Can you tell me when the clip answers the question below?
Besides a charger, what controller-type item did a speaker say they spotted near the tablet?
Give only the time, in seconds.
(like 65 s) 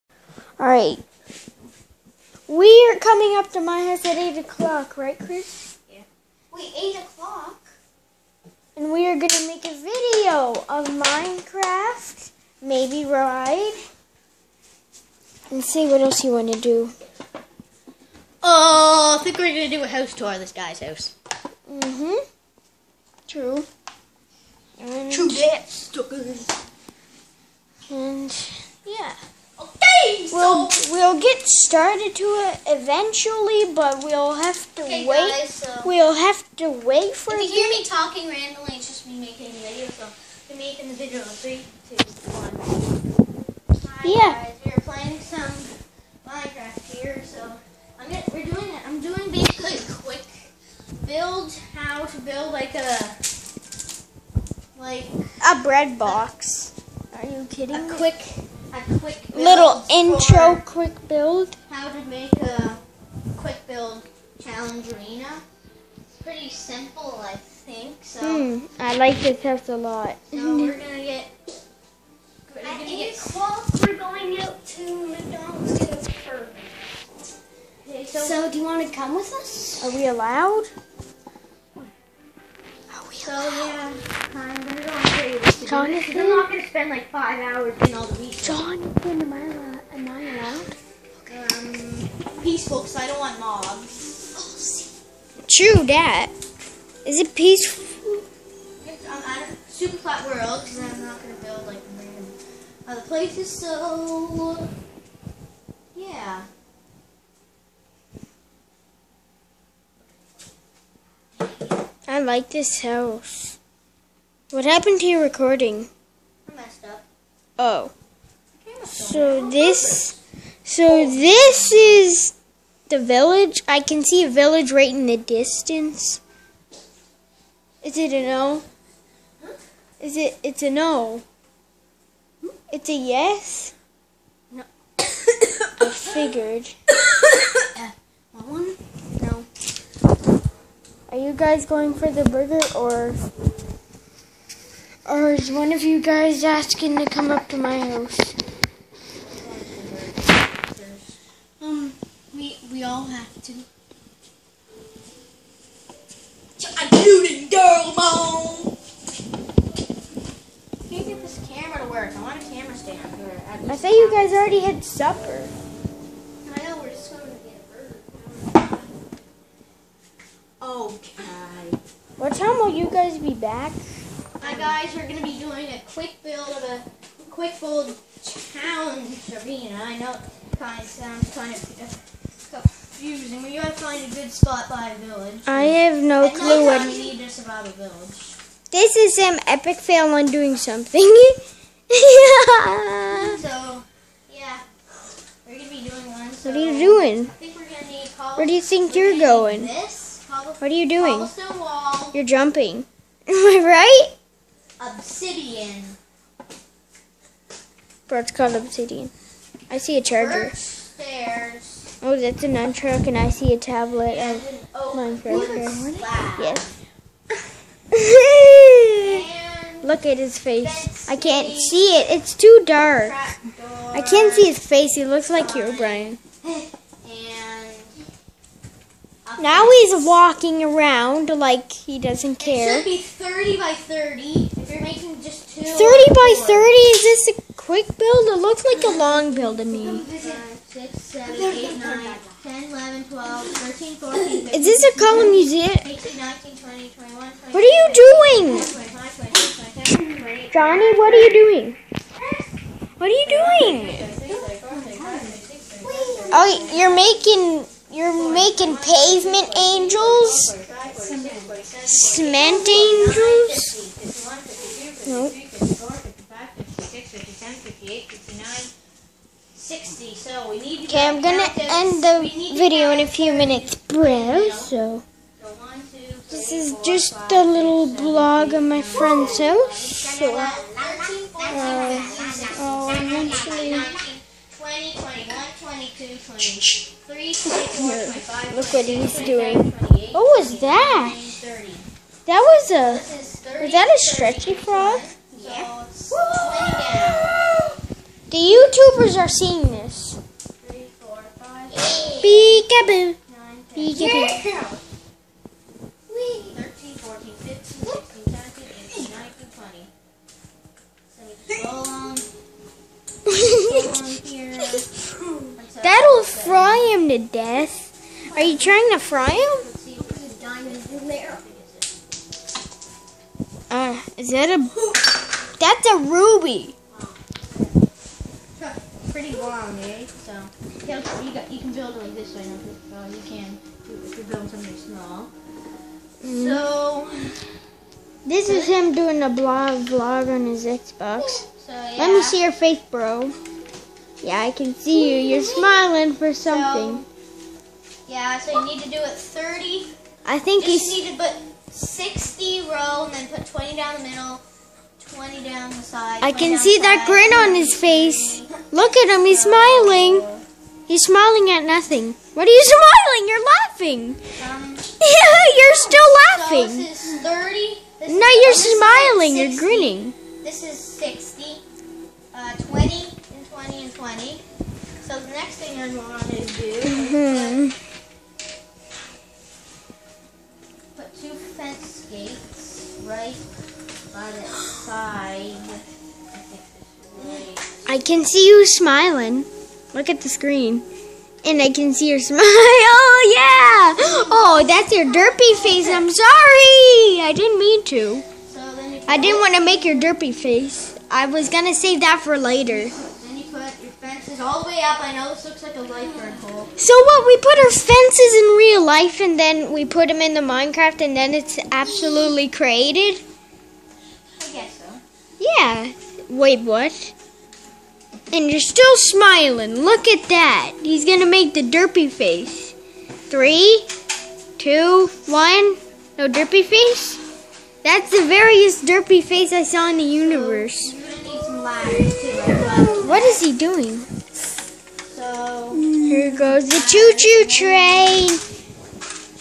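212 s.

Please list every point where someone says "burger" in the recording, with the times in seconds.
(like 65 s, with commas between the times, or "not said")
142 s, 168 s.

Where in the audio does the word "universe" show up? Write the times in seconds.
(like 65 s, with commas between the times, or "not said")
430 s.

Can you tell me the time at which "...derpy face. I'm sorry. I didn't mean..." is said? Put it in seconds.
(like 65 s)
395 s.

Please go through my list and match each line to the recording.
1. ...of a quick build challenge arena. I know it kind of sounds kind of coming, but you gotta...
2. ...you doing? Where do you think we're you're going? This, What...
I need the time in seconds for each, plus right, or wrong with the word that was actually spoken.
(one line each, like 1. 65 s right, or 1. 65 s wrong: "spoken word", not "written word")
1. 176 s wrong: "confusing", not "coming"
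2. 196 s right.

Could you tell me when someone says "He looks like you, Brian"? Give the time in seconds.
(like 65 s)
224 s.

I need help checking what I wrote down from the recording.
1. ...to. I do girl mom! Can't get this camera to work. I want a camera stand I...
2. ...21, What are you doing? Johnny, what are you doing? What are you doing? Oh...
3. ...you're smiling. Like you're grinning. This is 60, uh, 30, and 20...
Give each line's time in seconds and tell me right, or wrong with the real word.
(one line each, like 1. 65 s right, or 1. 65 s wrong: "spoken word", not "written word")
1. 153 s right
2. 246 s right
3. 368 s wrong: "20", not "30".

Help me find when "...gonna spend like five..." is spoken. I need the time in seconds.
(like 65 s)
86 s.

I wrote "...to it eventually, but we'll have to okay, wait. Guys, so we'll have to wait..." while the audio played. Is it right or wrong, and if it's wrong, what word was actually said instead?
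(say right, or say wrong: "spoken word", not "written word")
right.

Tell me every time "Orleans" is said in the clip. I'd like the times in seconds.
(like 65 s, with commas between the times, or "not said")
not said.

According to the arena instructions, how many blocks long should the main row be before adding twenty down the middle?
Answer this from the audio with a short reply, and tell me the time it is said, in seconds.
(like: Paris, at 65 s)
60, at 351 s.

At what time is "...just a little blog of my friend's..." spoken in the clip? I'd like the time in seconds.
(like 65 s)
276 s.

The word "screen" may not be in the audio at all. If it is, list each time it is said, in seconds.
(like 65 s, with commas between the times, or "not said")
390 s.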